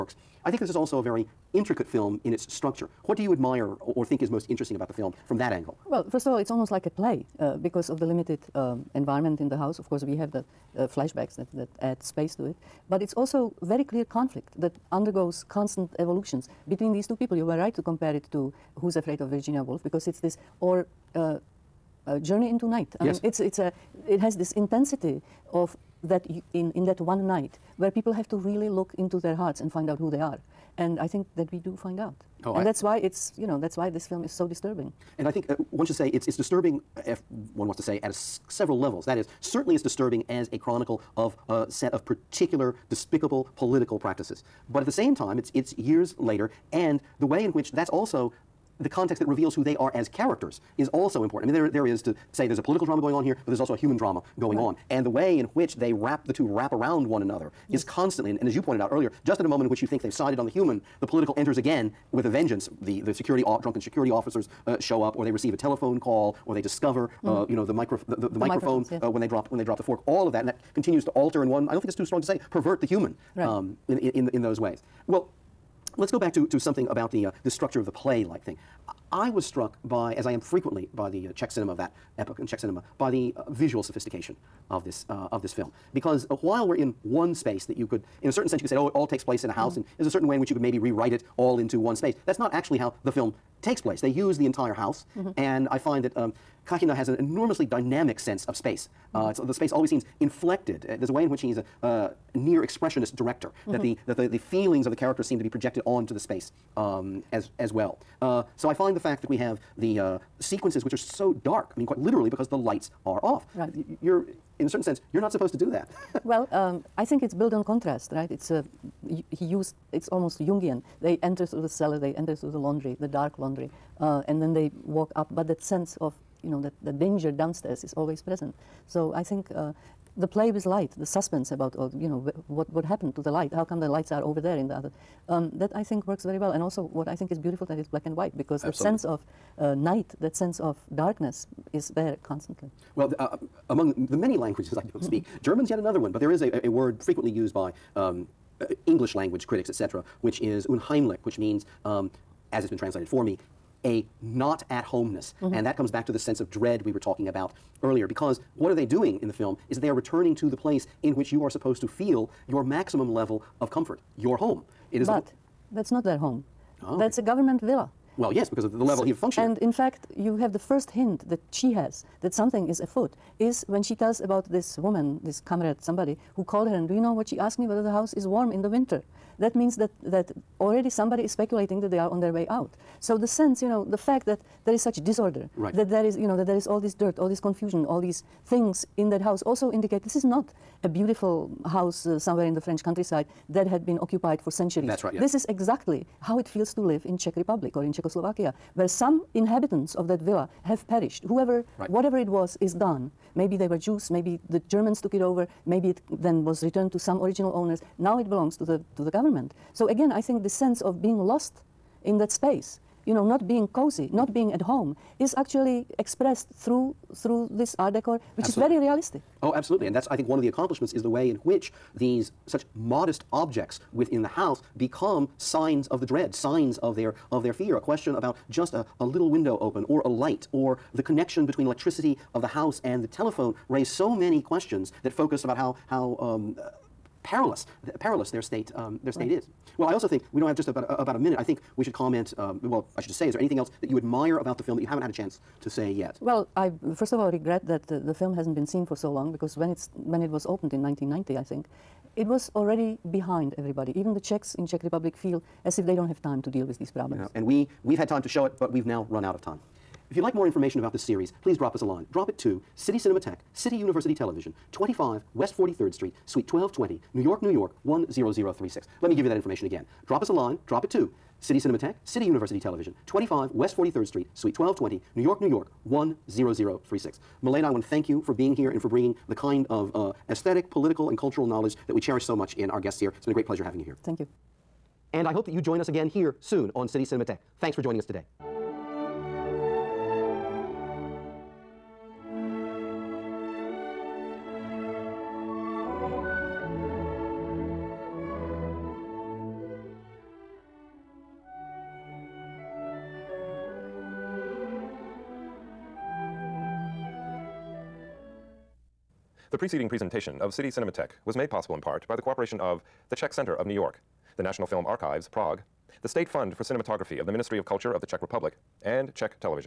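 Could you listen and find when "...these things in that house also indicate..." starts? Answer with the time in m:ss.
3:08.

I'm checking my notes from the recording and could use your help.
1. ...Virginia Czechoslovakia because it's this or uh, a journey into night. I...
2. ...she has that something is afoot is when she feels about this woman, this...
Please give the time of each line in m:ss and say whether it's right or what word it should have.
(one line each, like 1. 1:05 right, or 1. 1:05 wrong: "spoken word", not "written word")
1. 0:19 wrong: "Woolf", not "Czechoslovakia"
2. 2:51 wrong: "tells", not "feels".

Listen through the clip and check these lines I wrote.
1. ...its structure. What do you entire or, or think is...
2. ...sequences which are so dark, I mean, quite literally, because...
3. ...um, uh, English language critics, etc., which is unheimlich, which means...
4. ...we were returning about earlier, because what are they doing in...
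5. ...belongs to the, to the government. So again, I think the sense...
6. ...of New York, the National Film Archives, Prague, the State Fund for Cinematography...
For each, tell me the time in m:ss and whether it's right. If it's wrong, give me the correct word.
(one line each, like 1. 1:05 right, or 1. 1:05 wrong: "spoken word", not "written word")
1. 0:02 wrong: "admire", not "entire"
2. 1:50 right
3. 2:27 right
4. 2:36 wrong: "talking", not "returning"
5. 3:28 right
6. 5:13 right.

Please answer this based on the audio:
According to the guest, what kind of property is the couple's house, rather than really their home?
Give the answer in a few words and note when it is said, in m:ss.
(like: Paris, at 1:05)
a government villa, at 2:47.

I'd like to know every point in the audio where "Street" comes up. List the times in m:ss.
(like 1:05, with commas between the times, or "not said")
4:25, 4:34.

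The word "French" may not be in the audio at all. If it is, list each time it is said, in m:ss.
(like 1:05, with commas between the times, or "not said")
3:12.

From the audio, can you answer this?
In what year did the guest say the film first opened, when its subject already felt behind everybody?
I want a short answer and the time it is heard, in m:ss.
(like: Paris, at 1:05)
1990, at 4:10.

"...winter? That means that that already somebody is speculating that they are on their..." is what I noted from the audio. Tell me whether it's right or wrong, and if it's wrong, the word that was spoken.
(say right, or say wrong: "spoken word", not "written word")
right.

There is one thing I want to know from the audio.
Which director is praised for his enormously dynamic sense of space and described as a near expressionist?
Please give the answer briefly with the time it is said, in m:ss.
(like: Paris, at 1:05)
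Kachyna, at 1:36.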